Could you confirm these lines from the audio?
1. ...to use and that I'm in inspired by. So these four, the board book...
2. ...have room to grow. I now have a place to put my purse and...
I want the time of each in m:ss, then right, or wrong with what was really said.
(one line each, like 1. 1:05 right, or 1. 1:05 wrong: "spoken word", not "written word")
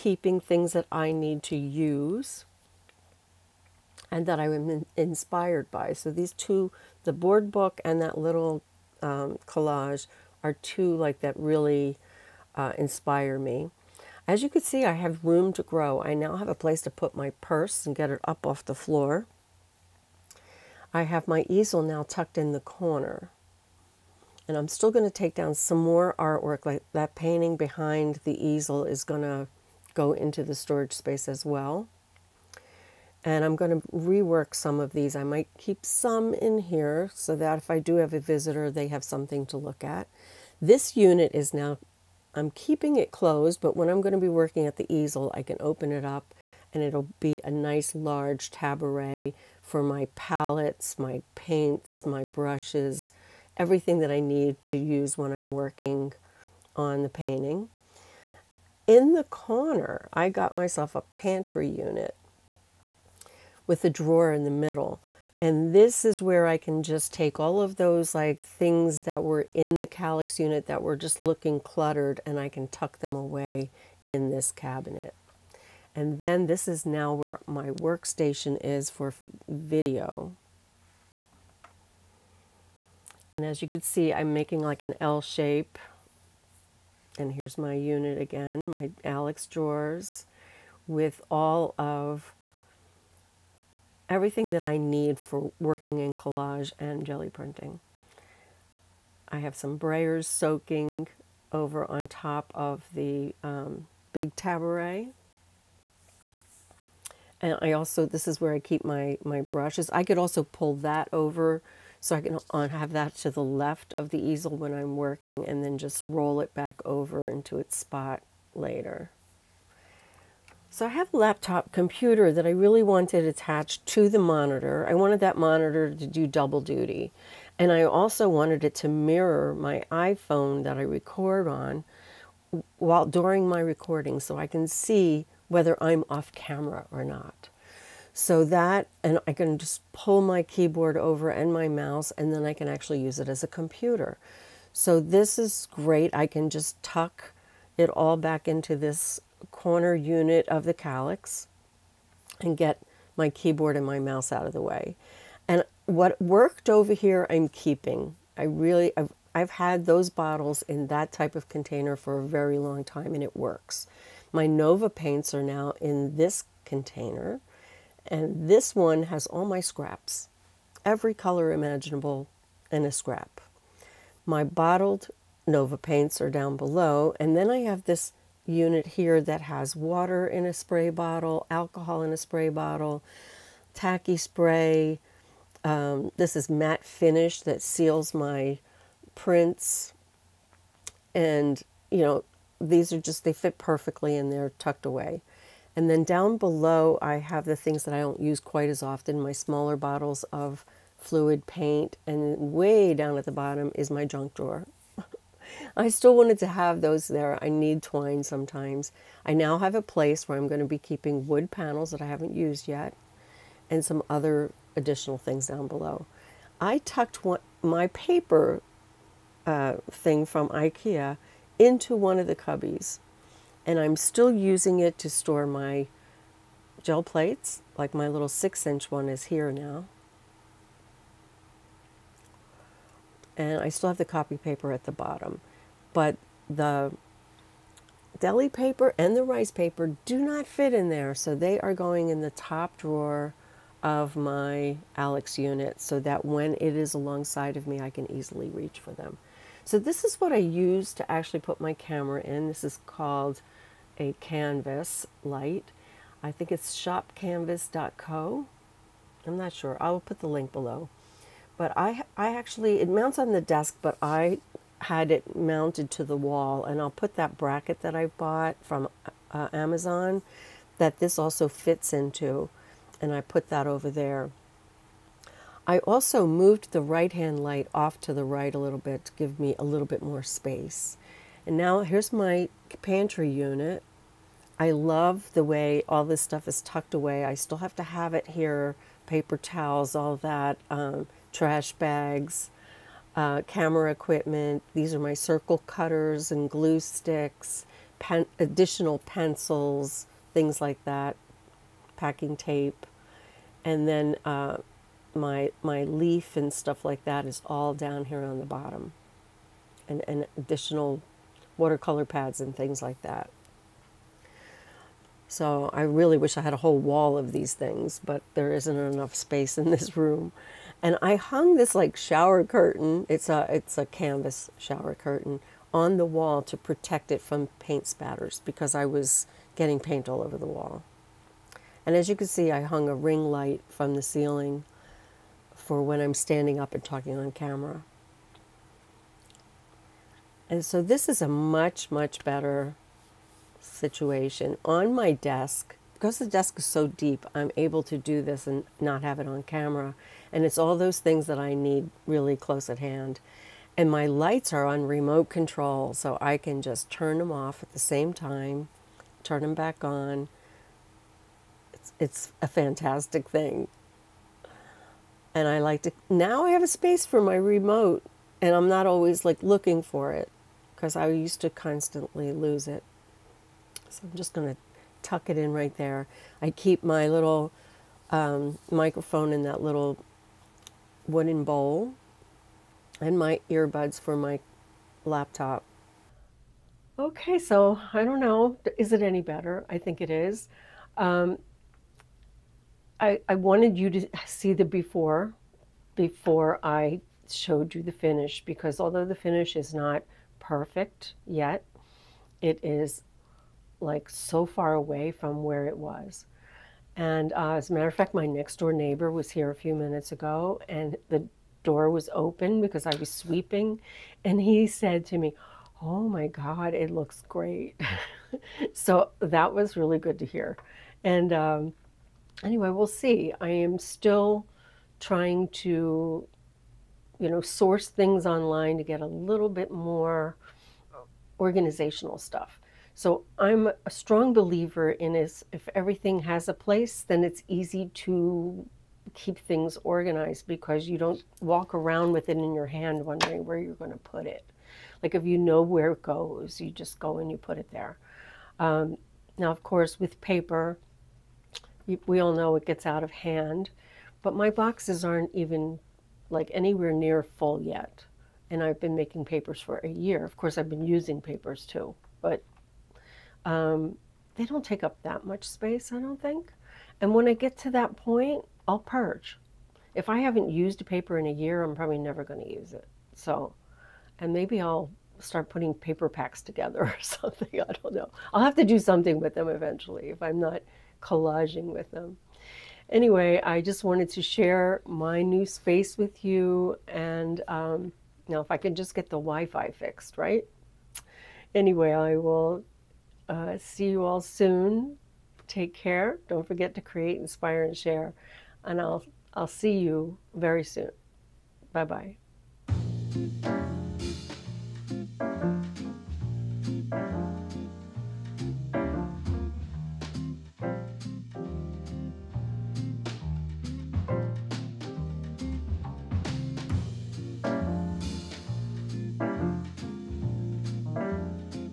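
1. 0:01 wrong: "two", not "four"
2. 0:14 right.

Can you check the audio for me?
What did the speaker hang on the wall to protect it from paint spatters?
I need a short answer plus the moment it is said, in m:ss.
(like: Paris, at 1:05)
canvas shower curtain, at 5:23.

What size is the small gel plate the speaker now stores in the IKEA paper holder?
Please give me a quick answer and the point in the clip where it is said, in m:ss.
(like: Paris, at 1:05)
6 inch, at 3:48.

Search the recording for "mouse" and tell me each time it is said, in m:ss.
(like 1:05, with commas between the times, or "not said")
2:21, 2:33.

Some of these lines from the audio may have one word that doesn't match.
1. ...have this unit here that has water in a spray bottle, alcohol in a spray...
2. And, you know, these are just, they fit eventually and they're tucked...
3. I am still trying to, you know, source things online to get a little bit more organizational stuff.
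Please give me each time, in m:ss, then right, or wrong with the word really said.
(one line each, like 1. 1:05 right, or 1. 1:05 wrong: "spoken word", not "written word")
1. 2:57 right
2. 3:11 wrong: "perfectly", not "eventually"
3. 7:03 right.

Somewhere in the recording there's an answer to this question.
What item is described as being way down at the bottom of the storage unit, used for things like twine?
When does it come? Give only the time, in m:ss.
3:24.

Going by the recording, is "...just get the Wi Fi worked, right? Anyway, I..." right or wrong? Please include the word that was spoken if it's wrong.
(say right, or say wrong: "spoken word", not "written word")
wrong: "fixed", not "worked".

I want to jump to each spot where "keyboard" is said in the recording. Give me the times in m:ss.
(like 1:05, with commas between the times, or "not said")
2:20, 2:33.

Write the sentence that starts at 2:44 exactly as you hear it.
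My Nova paints are now in this container, and this one has all my scraps, every color imaginable and a scrap.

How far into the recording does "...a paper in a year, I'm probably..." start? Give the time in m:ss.
7:50.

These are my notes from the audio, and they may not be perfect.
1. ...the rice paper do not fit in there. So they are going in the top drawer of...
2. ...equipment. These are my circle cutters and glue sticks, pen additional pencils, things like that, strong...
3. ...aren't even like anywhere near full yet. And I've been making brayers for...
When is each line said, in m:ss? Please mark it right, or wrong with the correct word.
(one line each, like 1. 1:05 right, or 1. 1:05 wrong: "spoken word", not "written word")
1. 3:59 right
2. 4:53 wrong: "packing", not "strong"
3. 7:35 wrong: "papers", not "brayers".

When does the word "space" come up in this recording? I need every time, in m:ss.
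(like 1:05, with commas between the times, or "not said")
0:30, 4:40, 5:19, 6:06, 7:45, 8:05.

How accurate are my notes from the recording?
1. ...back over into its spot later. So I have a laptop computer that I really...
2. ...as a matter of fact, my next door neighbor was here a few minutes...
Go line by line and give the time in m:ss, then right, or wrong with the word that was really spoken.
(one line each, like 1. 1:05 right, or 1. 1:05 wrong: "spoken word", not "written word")
1. 1:56 right
2. 6:47 right.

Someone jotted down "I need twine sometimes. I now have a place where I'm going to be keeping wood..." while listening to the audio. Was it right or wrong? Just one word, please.
right.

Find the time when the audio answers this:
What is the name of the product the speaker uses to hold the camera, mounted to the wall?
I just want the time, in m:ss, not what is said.
4:14.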